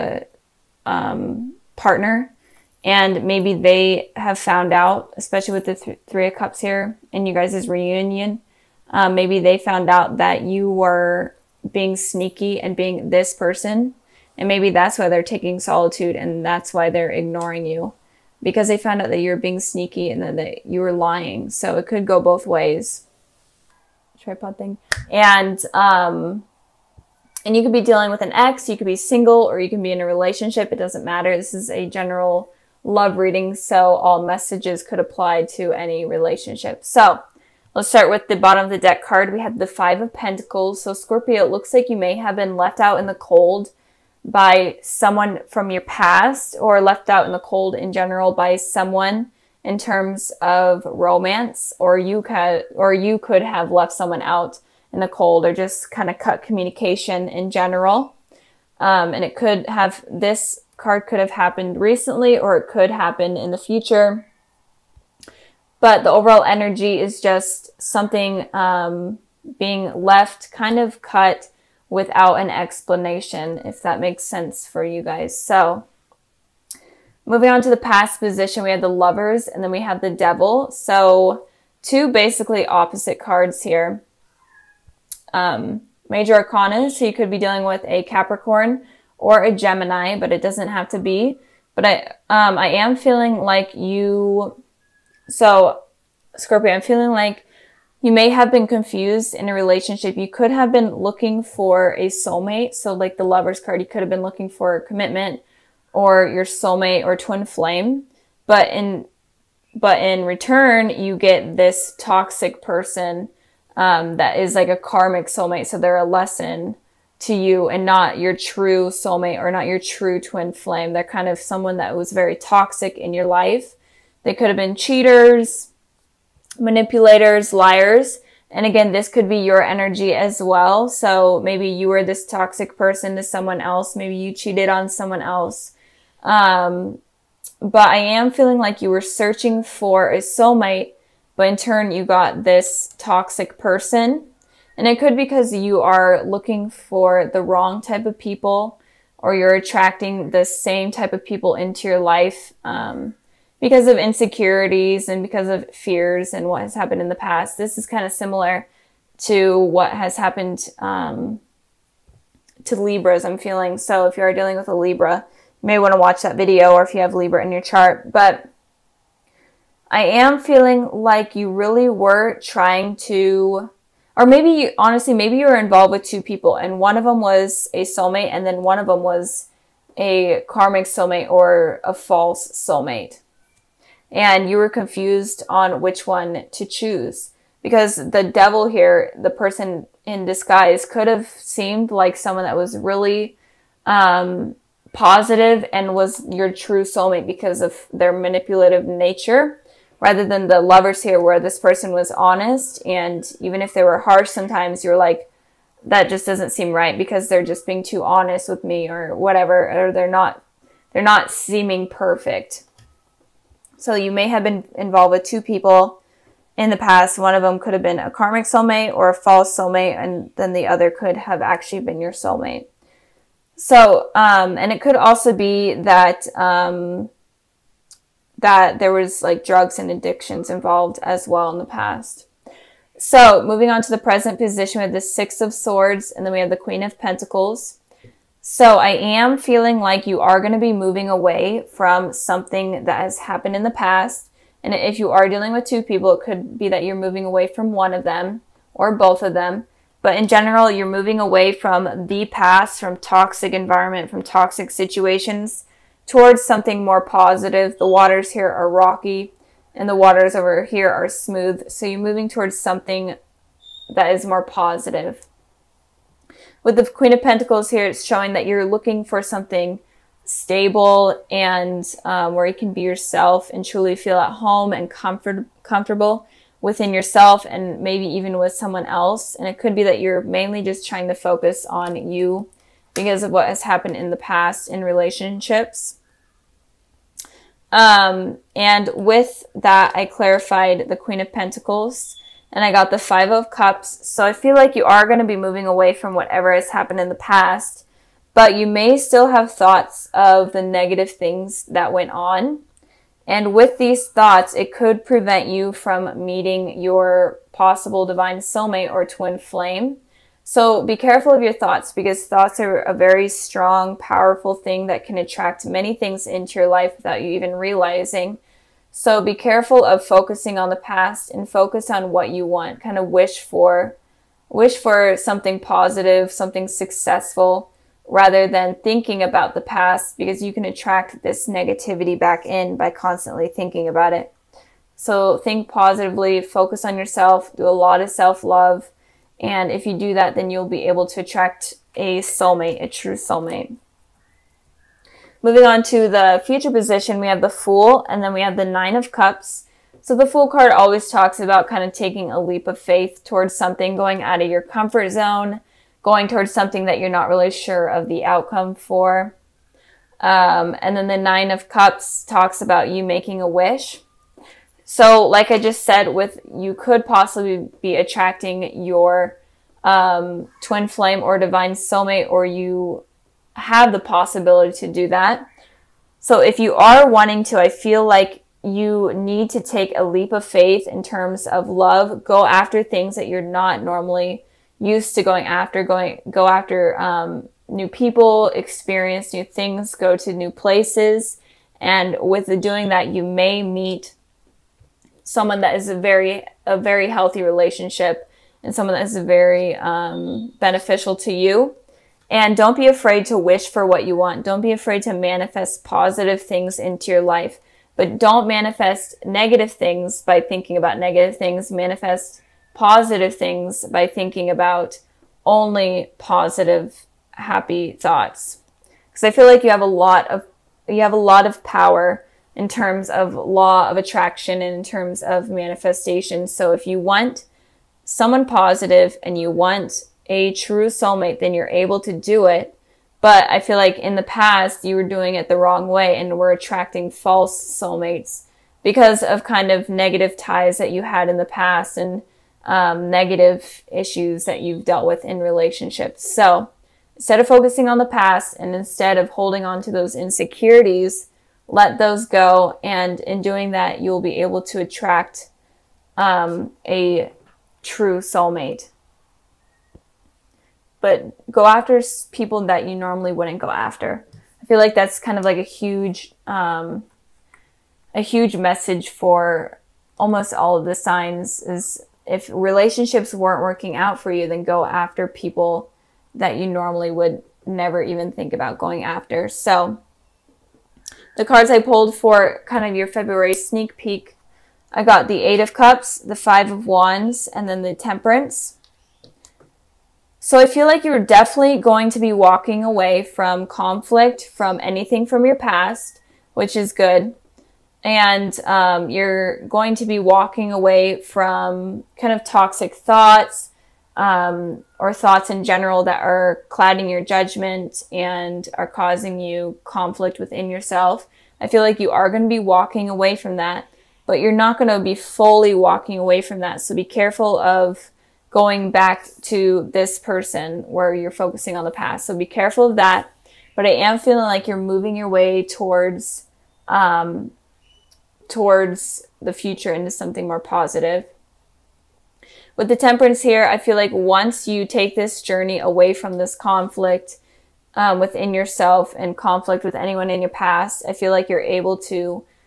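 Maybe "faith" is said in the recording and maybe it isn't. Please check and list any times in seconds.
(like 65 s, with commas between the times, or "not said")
352 s, 380 s.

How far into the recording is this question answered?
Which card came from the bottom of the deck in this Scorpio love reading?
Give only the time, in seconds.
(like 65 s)
39 s.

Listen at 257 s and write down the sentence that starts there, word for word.
The waters here are rocky and the waters over here are smooth.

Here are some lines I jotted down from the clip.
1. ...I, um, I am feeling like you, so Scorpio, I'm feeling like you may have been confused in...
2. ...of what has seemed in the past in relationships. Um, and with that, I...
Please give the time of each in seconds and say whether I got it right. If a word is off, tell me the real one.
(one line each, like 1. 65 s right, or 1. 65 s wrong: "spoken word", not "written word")
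1. 91 s right
2. 283 s wrong: "happened", not "seemed".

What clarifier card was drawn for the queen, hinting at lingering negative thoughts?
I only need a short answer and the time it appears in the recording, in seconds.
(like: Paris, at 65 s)
Five of Cups, at 292 s.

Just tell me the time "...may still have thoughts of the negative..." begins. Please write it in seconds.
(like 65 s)
298 s.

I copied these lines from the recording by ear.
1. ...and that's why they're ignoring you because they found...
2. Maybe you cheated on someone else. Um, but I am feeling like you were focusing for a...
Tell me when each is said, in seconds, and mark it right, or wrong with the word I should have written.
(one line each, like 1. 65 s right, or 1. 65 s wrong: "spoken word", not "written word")
1. 16 s right
2. 133 s wrong: "searching", not "focusing".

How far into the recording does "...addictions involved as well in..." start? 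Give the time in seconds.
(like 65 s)
229 s.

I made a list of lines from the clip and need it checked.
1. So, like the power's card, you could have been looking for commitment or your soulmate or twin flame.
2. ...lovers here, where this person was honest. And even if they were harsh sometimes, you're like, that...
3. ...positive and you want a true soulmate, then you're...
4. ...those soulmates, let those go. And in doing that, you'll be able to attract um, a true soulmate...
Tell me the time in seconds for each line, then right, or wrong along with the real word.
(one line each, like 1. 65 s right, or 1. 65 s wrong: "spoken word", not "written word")
1. 102 s wrong: "lover", not "power"
2. 200 s right
3. 428 s right
4. 449 s wrong: "insecurities", not "soulmates".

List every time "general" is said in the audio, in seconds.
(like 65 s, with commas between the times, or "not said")
31 s, 47 s, 57 s, 250 s, 505 s.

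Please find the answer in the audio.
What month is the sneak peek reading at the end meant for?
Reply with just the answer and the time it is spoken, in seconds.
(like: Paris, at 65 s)
February, at 483 s.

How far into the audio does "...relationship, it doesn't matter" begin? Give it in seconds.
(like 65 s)
30 s.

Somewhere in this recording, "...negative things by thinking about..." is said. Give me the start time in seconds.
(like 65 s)
409 s.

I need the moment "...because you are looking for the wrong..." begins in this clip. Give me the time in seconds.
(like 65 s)
145 s.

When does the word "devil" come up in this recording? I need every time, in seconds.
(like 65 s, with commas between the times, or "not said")
80 s, 188 s.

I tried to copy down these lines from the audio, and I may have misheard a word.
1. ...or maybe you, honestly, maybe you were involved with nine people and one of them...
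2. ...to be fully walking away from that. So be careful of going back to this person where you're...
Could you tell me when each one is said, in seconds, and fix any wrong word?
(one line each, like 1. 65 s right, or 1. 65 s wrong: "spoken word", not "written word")
1. 174 s wrong: "two", not "nine"
2. 514 s right.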